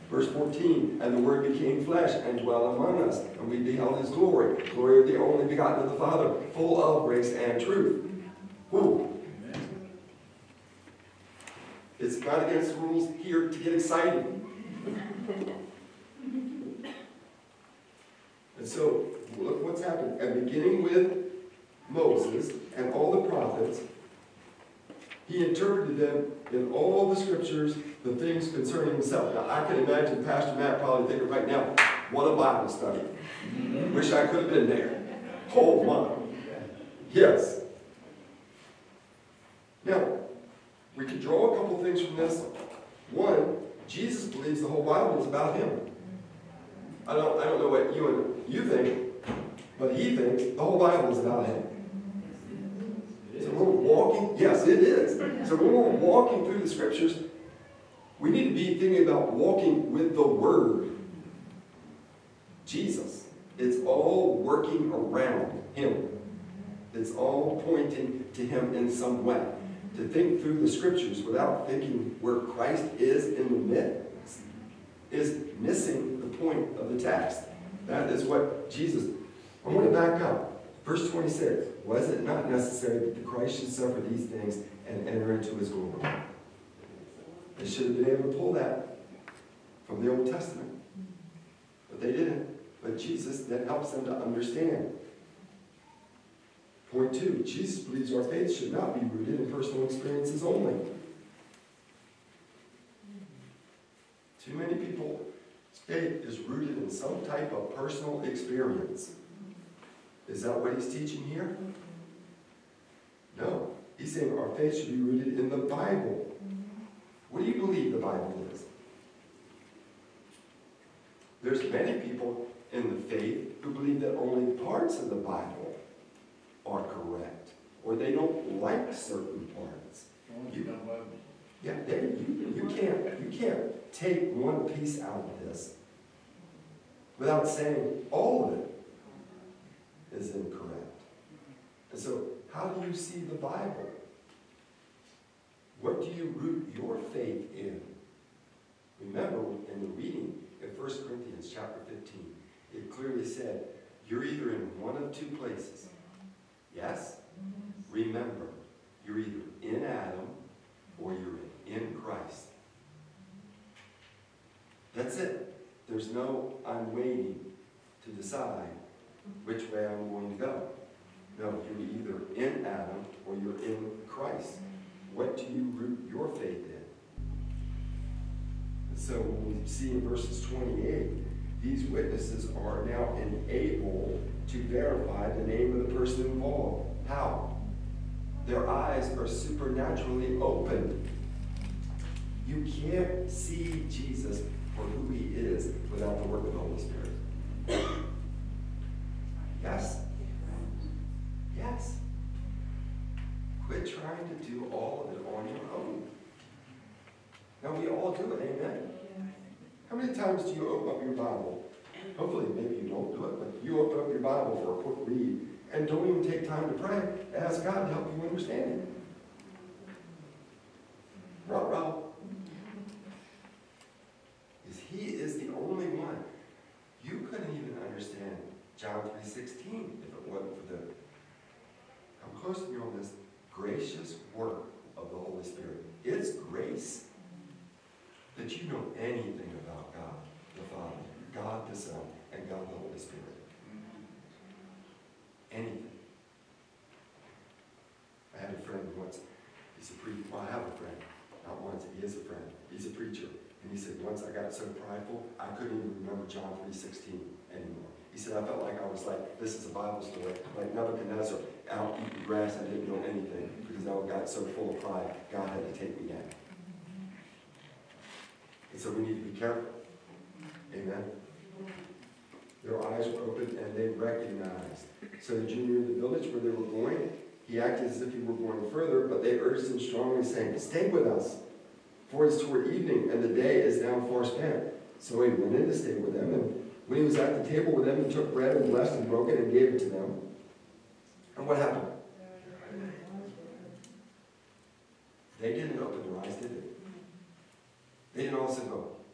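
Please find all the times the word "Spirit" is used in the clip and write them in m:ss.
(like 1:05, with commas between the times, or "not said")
3:16, 3:55, 4:02.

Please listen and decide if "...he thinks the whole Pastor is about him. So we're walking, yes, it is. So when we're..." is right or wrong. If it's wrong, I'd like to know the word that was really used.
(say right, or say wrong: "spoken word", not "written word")
wrong: "Bible", not "Pastor".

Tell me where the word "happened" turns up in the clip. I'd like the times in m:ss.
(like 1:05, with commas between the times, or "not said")
0:19, 4:51.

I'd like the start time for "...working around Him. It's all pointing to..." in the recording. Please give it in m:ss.
1:04.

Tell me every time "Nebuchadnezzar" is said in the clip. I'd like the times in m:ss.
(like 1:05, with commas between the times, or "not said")
4:20.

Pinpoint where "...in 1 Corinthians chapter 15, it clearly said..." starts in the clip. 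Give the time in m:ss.
2:30.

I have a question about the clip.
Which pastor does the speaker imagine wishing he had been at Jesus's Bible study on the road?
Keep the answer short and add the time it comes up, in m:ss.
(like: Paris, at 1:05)
Pastor Matt, at 0:30.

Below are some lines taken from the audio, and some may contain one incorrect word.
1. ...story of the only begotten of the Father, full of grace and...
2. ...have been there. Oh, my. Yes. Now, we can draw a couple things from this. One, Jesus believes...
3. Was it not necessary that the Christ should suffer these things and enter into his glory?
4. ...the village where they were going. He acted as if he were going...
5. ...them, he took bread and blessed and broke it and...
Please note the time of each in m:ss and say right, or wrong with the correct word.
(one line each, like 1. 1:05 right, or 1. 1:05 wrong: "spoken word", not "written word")
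1. 0:04 wrong: "glory", not "story"
2. 0:34 right
3. 1:21 right
4. 4:35 right
5. 4:47 right.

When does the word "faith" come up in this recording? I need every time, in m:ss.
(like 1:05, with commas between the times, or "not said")
1:38, 1:45, 1:54, 2:03, 2:27, 2:56.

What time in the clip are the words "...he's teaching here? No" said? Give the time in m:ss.
1:50.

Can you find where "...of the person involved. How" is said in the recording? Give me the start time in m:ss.
3:05.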